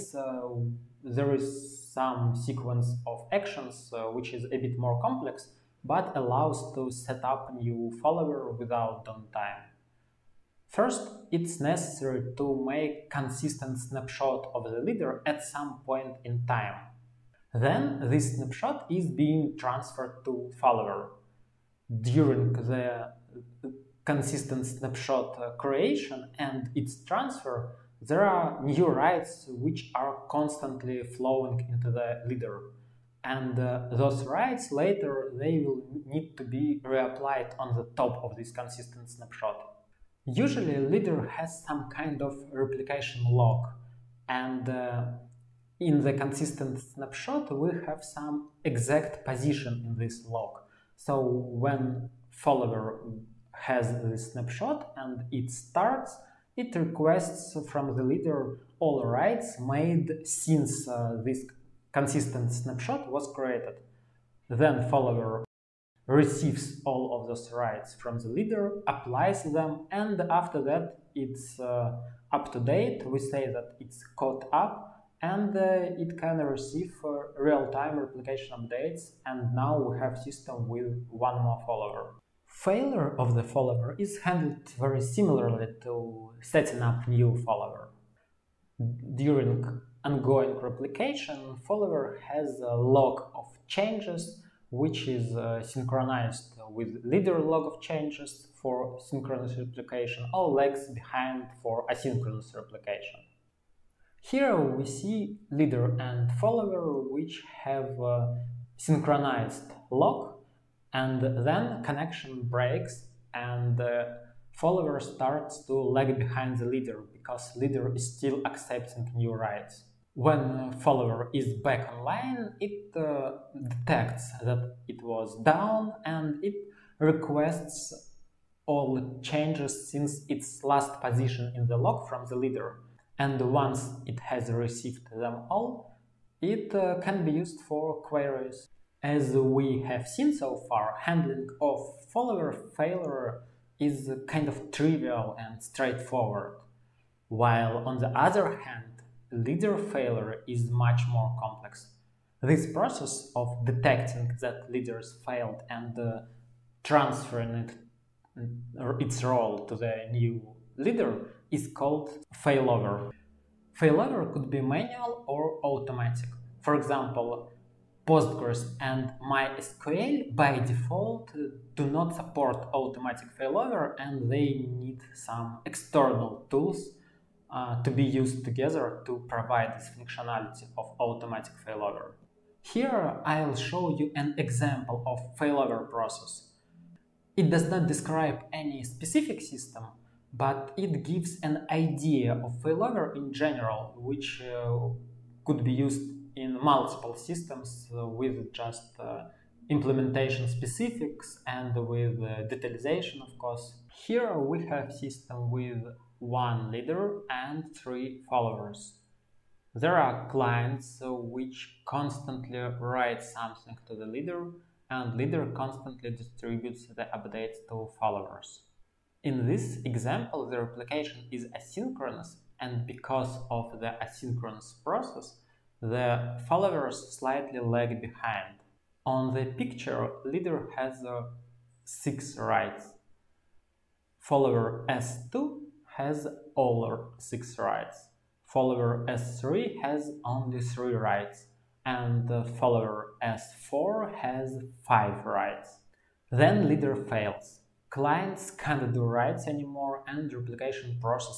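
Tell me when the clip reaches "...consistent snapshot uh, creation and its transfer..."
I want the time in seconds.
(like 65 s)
24 s.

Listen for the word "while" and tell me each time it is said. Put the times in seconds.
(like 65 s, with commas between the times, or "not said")
147 s.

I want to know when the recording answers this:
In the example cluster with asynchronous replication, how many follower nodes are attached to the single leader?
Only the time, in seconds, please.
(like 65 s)
207 s.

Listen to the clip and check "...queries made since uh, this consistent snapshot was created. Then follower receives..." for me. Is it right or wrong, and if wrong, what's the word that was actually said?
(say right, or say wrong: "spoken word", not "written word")
wrong: "writes", not "queries".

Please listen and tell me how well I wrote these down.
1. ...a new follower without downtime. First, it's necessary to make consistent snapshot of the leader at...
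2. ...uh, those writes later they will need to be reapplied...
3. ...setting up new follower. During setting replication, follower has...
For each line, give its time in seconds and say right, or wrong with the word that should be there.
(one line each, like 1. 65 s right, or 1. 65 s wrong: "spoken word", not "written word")
1. 7 s right
2. 33 s right
3. 86 s wrong: "ongoing", not "setting".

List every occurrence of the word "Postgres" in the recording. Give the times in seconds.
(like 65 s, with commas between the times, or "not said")
168 s.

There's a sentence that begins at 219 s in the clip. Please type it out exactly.
In this example, the replication is asynchronous, and because of the asynchronous process, the followers slightly lag behind.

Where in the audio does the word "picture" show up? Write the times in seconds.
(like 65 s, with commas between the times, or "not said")
229 s.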